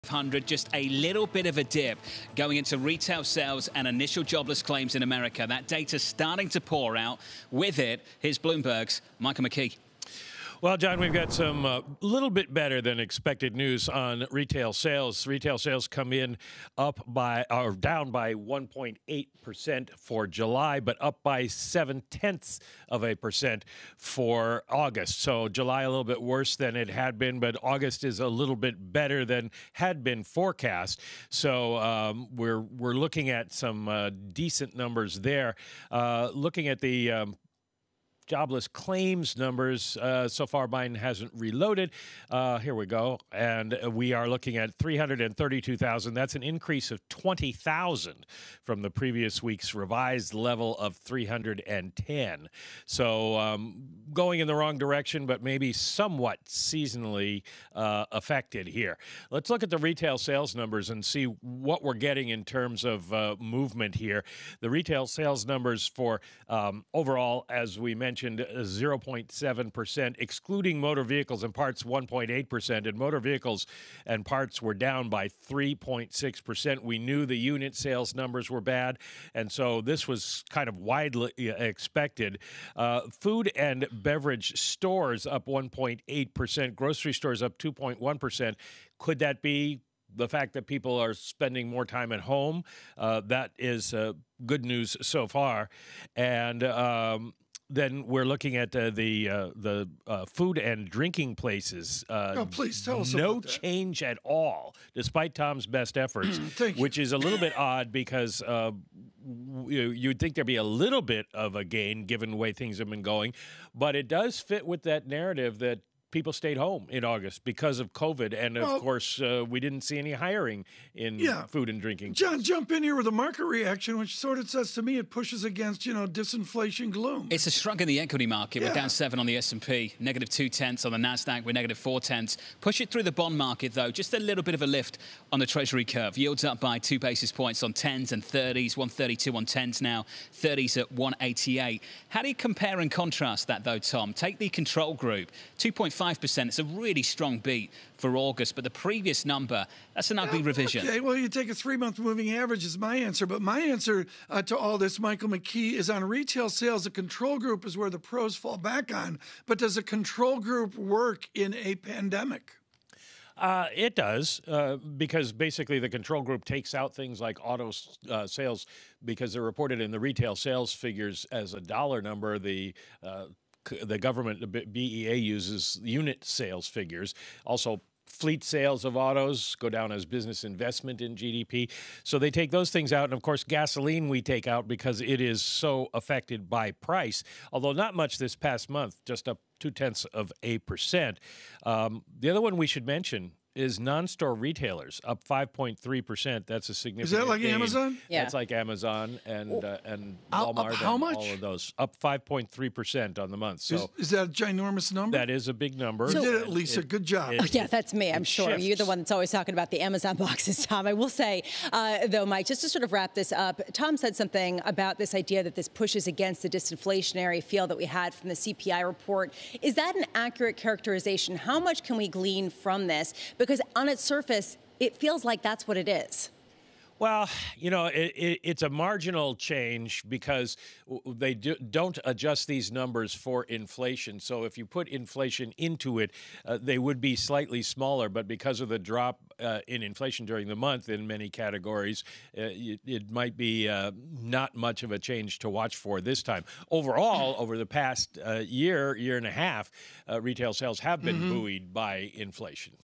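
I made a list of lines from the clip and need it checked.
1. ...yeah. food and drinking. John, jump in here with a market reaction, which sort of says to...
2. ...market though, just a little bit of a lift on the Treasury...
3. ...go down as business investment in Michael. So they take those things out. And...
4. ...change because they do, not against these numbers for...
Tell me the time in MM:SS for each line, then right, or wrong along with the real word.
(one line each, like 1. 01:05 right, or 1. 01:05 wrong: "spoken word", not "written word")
1. 02:01 right
2. 02:13 right
3. 02:59 wrong: "GDP", not "Michael"
4. 03:49 wrong: "adjust", not "against".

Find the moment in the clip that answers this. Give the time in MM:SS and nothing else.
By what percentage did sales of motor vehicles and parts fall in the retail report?
01:15.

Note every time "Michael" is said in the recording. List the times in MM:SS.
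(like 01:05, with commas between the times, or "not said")
00:09, 02:34.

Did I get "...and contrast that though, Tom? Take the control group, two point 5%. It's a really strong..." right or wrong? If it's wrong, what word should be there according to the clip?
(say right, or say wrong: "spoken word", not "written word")
right.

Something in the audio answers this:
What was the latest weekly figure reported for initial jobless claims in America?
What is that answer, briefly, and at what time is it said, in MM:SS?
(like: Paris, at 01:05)
332,000, at 00:44.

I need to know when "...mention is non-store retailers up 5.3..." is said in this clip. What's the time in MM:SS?
03:12.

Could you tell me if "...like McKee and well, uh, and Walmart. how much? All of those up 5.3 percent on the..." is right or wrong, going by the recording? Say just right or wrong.
wrong.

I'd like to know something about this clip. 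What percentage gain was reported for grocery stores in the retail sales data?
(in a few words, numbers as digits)
2.1%.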